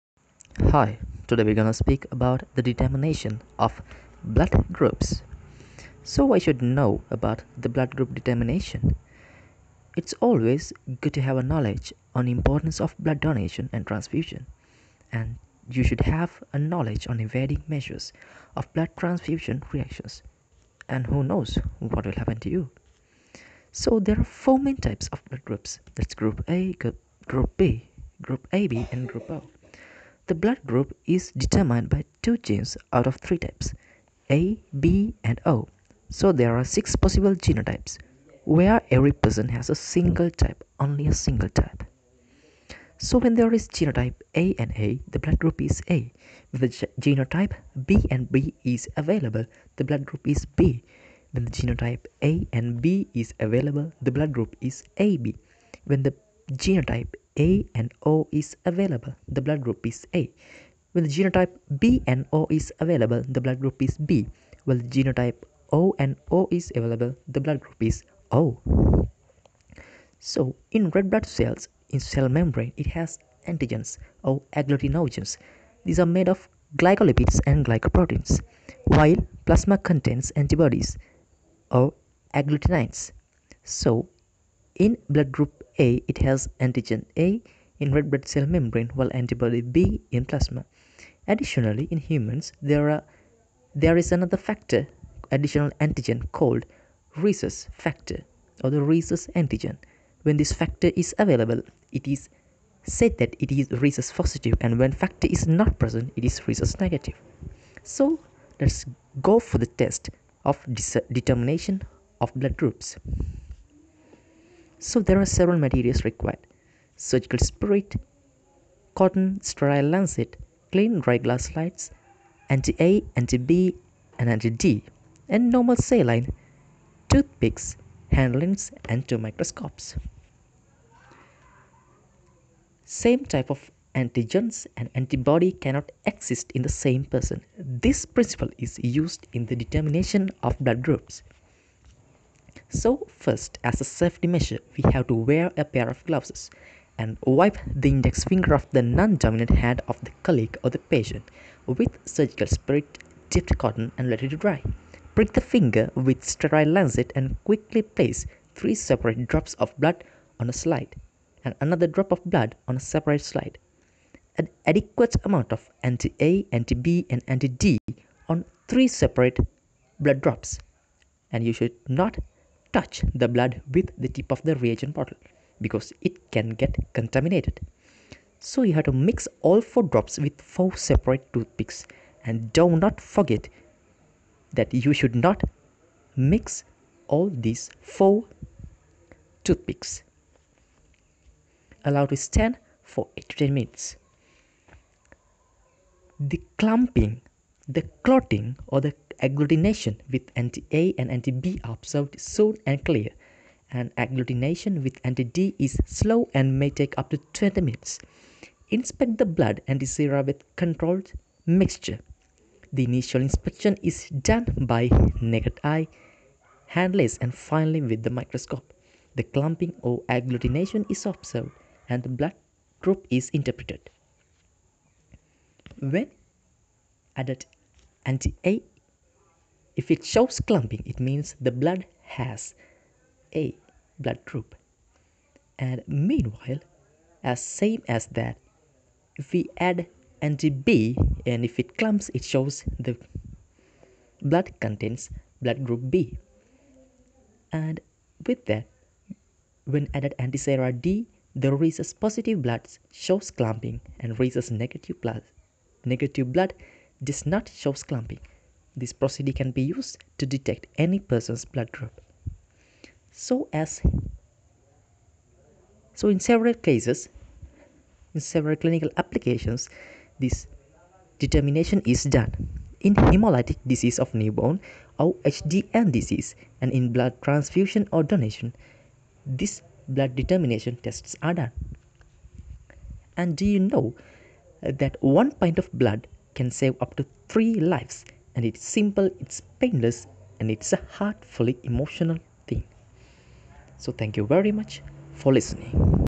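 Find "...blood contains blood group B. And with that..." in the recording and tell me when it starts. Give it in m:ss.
4:04.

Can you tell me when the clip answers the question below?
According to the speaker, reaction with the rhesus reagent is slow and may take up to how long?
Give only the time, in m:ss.
3:27.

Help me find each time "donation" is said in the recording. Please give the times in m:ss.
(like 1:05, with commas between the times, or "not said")
0:13, 4:38.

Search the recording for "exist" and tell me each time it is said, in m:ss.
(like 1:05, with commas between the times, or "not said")
2:16.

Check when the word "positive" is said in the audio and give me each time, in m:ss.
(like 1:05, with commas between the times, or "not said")
1:44, 4:11.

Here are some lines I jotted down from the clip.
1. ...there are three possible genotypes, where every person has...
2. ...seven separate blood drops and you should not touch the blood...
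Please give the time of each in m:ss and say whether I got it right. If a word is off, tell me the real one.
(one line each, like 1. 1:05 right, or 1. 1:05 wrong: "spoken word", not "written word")
1. 0:36 wrong: "six", not "three"
2. 2:48 wrong: "three", not "seven".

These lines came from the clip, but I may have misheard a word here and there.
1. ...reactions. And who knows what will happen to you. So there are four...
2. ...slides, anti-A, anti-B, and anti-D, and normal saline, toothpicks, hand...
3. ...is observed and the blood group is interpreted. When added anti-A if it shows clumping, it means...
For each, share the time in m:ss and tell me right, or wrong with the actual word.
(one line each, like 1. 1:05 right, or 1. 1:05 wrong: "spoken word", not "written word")
1. 0:19 right
2. 2:01 right
3. 3:40 right.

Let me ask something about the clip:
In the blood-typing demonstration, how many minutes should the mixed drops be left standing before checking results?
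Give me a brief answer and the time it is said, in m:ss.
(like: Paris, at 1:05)
8 minutes, at 3:13.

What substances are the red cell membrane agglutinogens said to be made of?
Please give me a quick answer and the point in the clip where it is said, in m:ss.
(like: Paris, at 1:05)
glycolipids and glycoproteins, at 1:16.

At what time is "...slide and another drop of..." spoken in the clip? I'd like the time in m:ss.
2:40.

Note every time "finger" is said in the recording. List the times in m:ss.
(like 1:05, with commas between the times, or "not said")
2:28, 2:35.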